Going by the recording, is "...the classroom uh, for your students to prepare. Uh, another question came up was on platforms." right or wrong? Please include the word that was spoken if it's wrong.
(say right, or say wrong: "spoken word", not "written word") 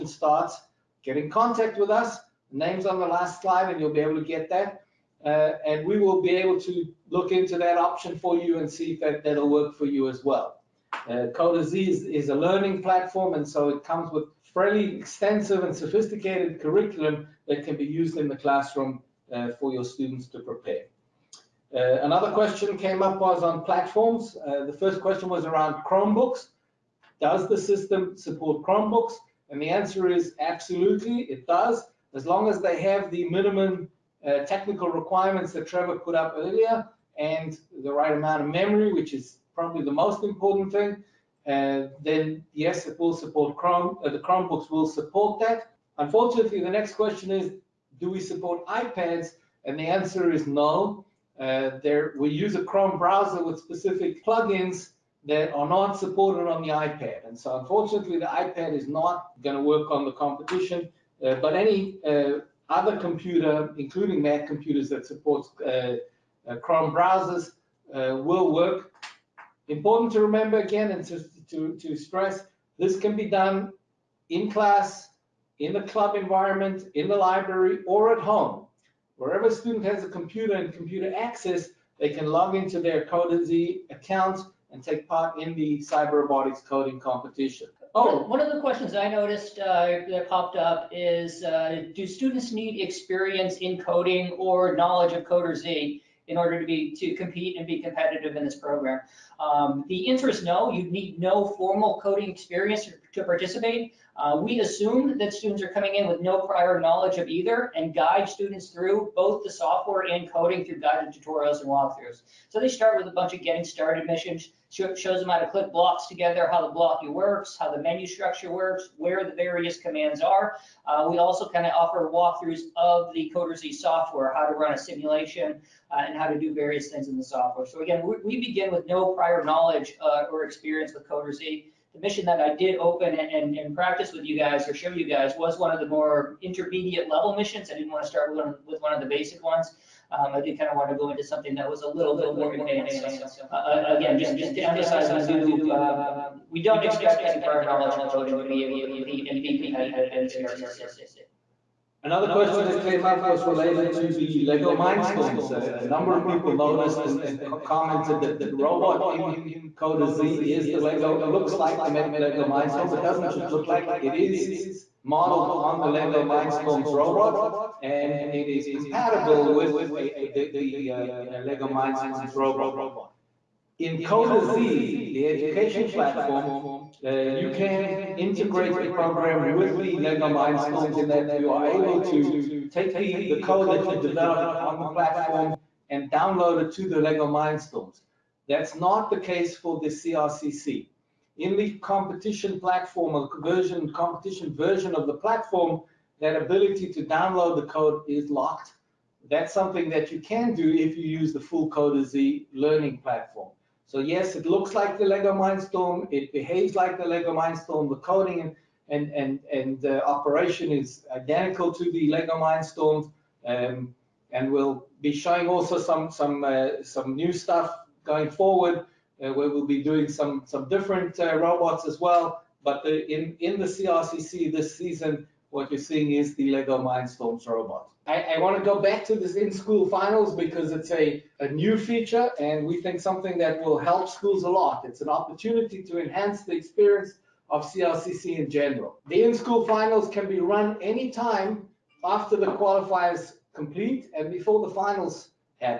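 right.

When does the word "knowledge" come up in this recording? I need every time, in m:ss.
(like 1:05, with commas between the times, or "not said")
1:34, 1:46, 2:09, 2:27.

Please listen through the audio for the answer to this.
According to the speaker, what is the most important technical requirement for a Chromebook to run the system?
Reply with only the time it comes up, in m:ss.
0:37.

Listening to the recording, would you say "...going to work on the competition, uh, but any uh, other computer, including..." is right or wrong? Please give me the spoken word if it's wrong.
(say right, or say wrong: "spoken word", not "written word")
right.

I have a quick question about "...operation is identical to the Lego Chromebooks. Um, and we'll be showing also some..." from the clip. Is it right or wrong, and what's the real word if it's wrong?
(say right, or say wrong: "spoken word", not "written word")
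wrong: "Mindstorm", not "Chromebooks".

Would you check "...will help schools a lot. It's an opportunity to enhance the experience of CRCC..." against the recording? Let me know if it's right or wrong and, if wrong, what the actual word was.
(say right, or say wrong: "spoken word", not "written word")
right.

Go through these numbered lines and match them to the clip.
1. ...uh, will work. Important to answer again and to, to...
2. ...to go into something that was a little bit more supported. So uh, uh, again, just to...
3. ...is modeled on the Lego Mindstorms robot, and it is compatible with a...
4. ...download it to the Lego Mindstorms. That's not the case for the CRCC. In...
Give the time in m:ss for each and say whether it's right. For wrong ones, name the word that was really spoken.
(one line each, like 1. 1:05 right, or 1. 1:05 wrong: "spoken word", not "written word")
1. 1:07 wrong: "remember", not "answer"
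2. 2:20 wrong: "advanced", not "supported"
3. 2:44 right
4. 3:06 right.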